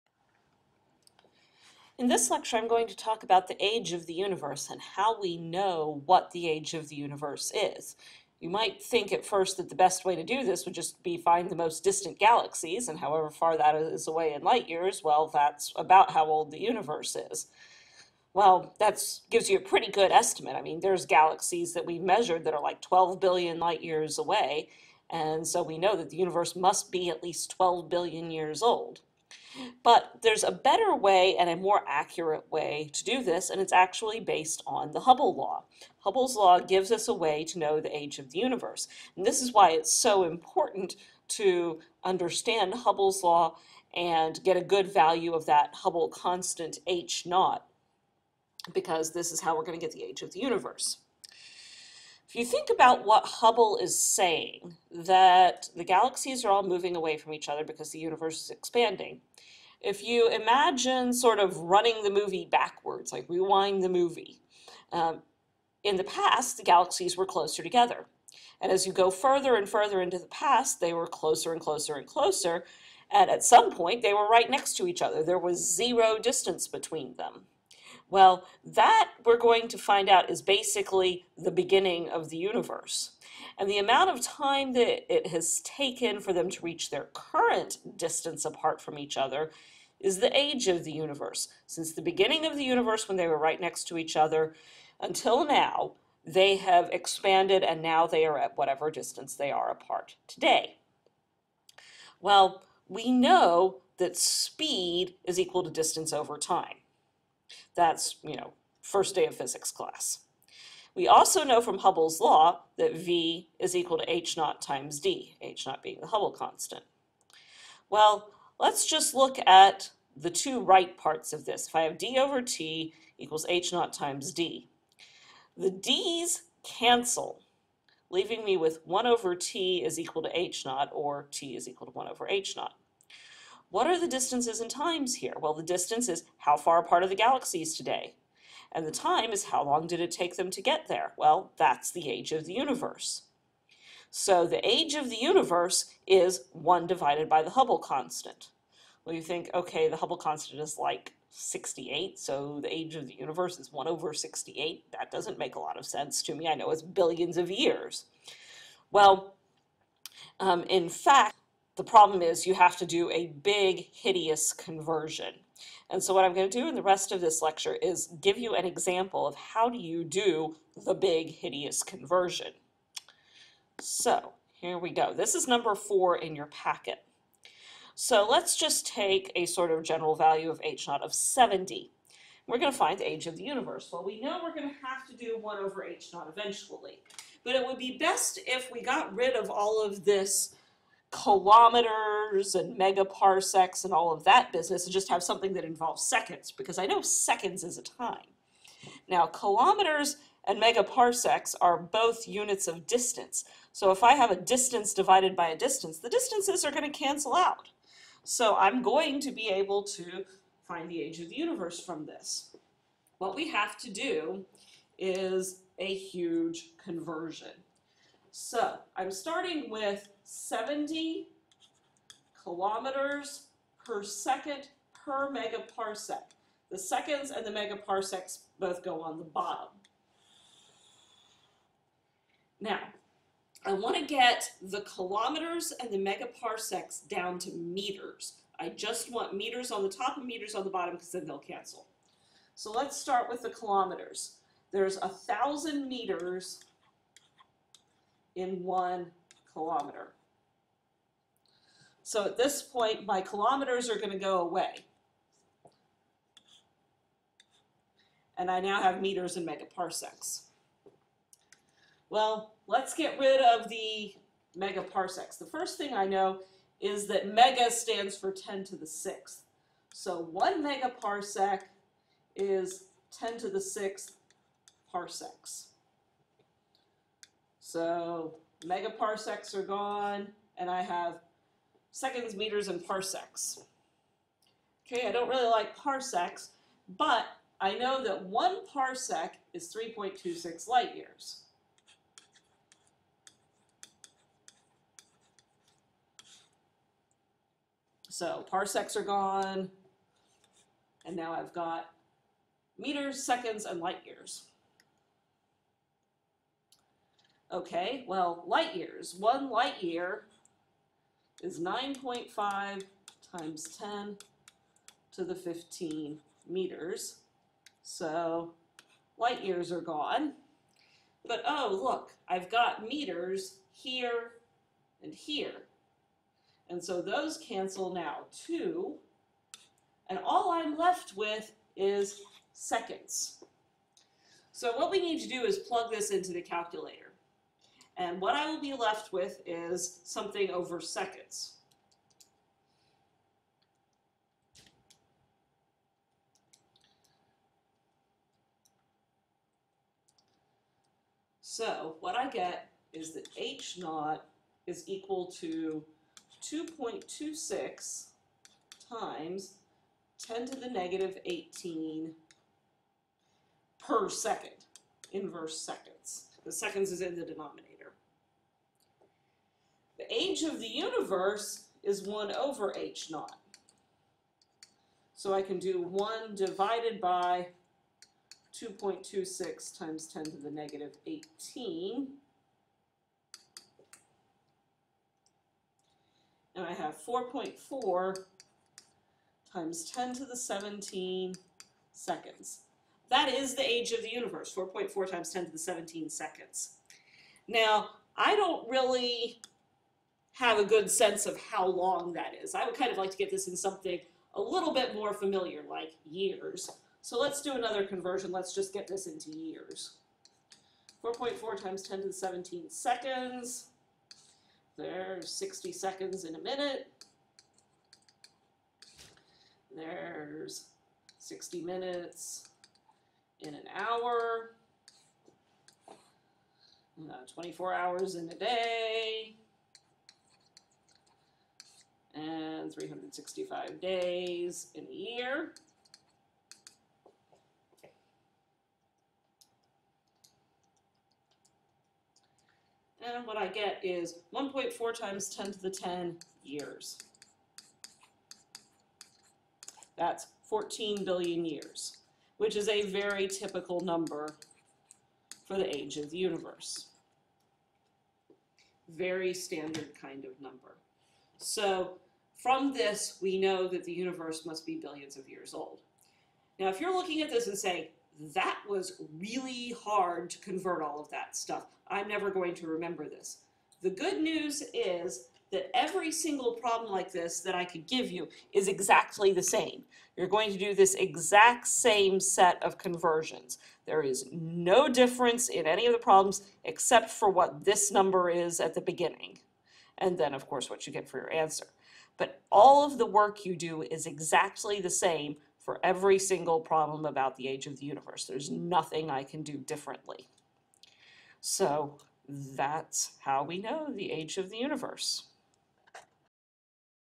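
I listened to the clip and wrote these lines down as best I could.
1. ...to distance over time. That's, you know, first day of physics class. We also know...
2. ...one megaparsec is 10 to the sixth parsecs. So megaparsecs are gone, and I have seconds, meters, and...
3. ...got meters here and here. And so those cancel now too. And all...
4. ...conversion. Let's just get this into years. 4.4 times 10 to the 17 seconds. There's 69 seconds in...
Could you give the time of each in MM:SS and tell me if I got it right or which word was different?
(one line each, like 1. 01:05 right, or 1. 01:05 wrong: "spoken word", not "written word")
1. 01:45 right
2. 04:30 right
3. 05:22 right
4. 06:47 wrong: "60", not "69".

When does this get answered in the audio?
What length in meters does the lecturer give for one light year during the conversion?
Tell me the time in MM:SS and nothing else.
05:11.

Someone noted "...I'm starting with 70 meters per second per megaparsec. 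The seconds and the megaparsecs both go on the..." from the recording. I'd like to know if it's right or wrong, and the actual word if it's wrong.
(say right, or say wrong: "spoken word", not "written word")
wrong: "kilometers", not "meters".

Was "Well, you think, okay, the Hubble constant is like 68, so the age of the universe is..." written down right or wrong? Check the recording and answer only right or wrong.
right.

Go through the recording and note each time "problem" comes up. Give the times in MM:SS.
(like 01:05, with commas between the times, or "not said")
02:41, 07:56, 08:05, 08:16.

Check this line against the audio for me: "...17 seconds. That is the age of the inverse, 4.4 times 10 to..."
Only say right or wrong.
wrong.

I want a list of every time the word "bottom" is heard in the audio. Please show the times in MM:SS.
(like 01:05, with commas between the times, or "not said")
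03:49, 04:00.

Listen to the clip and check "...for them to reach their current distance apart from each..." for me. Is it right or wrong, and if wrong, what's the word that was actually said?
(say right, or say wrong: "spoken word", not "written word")
right.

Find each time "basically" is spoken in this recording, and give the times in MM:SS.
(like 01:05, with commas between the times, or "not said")
01:20.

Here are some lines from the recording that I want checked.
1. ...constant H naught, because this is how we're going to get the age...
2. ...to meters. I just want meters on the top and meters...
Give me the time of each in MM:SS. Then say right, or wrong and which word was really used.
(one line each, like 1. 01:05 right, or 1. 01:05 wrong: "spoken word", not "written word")
1. 00:46 right
2. 03:57 right.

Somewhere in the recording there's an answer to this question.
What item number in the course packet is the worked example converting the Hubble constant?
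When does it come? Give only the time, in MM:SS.
02:55.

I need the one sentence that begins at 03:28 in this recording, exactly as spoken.
So I'm going to be able to find the age of the universe from this.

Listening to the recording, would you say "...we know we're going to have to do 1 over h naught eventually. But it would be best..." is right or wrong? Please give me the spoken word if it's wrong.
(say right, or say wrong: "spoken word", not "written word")
right.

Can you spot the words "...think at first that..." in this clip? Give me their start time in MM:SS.
00:08.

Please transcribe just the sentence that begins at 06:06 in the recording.
The seconds is in the denominator age of the universe is 1 over h naught.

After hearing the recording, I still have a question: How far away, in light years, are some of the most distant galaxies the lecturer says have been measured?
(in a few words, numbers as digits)
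12 billion light years.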